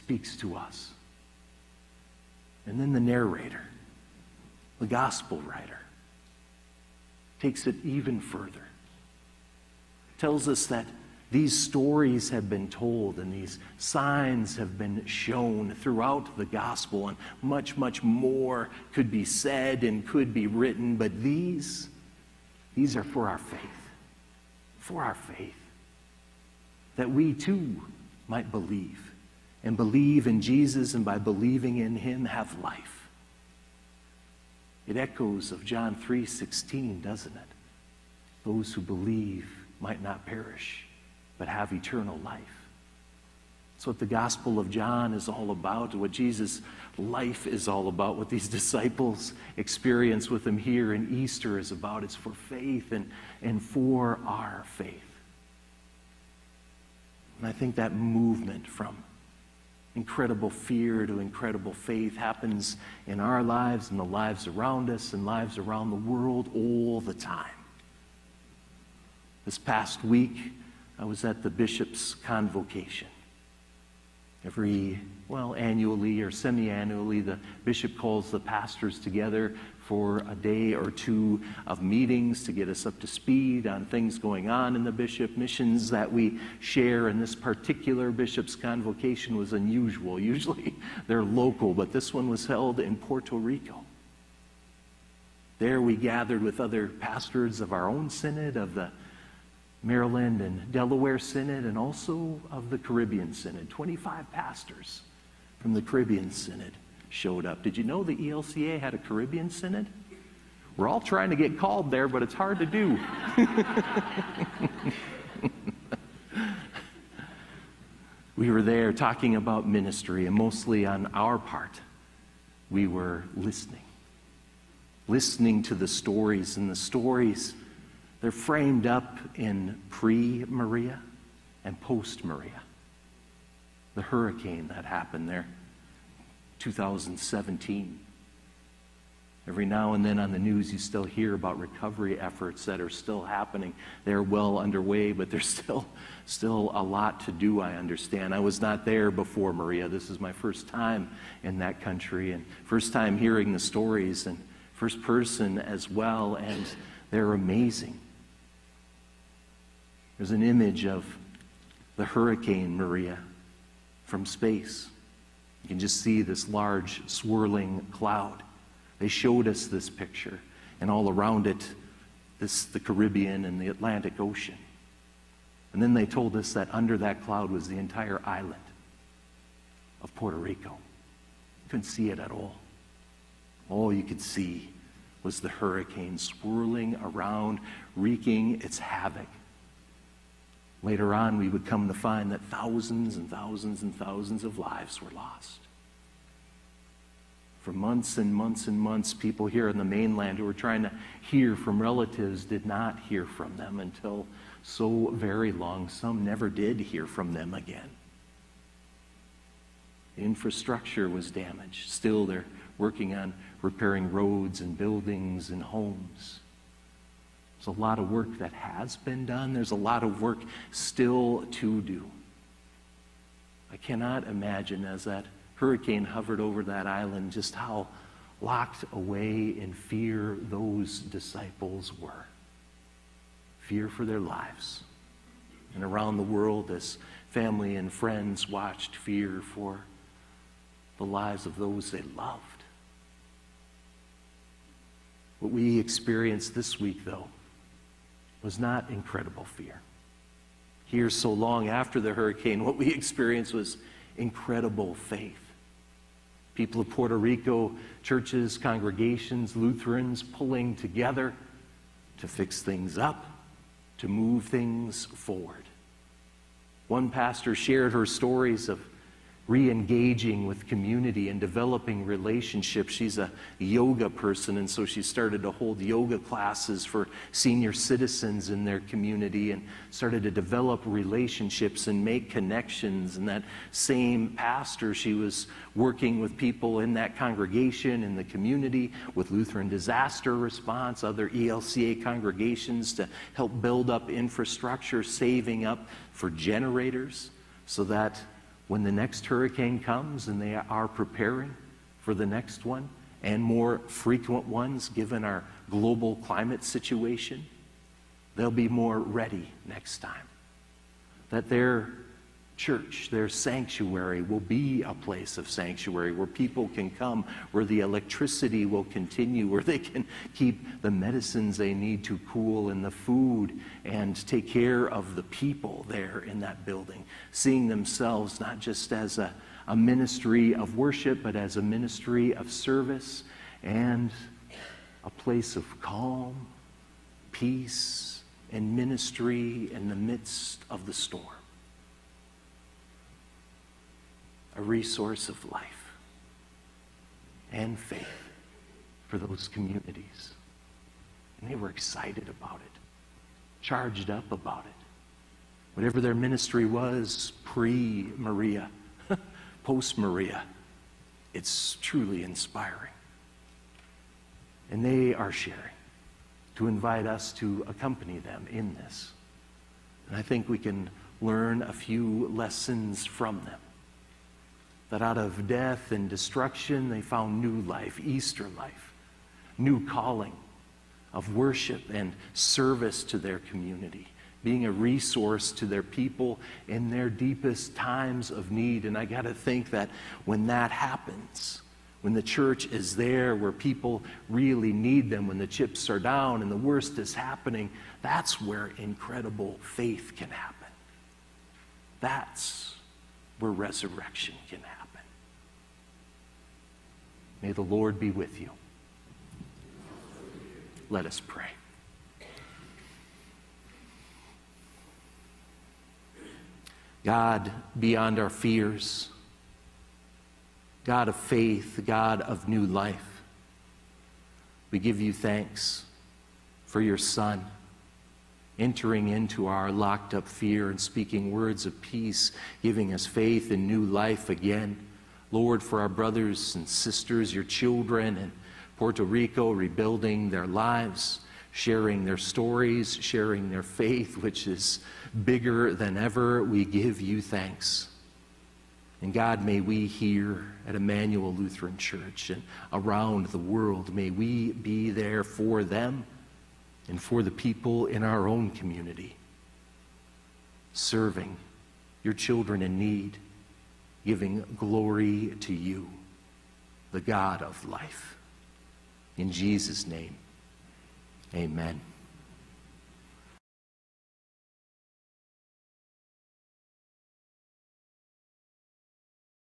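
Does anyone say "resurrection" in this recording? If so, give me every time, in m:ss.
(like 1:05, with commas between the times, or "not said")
6:43.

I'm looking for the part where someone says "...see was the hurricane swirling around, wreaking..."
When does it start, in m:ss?
3:04.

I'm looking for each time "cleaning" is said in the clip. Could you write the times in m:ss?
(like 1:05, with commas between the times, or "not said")
not said.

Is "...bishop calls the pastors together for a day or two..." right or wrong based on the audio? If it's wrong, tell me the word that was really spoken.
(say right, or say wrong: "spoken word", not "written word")
right.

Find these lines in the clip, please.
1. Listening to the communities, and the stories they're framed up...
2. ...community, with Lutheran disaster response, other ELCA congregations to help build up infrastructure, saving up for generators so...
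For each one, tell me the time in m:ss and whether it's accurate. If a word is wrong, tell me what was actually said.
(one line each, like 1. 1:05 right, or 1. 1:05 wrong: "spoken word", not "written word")
1. 2:05 wrong: "stories", not "communities"
2. 4:48 right.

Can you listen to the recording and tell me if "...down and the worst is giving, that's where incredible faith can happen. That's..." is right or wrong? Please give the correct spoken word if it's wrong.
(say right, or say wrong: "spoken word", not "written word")
wrong: "happening", not "giving".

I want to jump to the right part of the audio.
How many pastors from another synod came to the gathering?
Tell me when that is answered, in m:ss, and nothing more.
1:43.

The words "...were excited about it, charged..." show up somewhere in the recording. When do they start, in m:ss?
5:51.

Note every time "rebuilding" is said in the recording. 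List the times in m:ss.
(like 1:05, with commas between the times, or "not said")
7:19.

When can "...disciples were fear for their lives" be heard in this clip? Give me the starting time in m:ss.
3:50.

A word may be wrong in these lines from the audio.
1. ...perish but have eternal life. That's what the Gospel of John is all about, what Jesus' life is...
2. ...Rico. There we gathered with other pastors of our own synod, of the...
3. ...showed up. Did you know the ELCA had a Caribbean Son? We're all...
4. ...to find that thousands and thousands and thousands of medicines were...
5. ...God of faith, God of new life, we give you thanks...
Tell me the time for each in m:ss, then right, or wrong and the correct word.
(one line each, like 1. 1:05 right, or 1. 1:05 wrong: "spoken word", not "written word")
1. 0:40 right
2. 1:33 right
3. 1:47 wrong: "Synod", not "Son"
4. 3:11 wrong: "lives", not "medicines"
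5. 7:00 right.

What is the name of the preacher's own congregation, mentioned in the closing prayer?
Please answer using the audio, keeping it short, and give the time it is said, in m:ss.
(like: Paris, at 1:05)
Emmanuel Lutheran Church, at 7:30.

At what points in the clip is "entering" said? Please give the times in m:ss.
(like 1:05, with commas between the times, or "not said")
7:08.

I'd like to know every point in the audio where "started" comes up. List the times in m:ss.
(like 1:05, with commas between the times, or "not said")
4:35, 4:39.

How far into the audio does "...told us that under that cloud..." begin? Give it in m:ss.
2:56.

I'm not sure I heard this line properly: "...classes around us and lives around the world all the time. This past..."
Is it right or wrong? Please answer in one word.
wrong.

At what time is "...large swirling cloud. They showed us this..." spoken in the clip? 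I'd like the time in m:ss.
2:46.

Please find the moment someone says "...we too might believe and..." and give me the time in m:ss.
0:27.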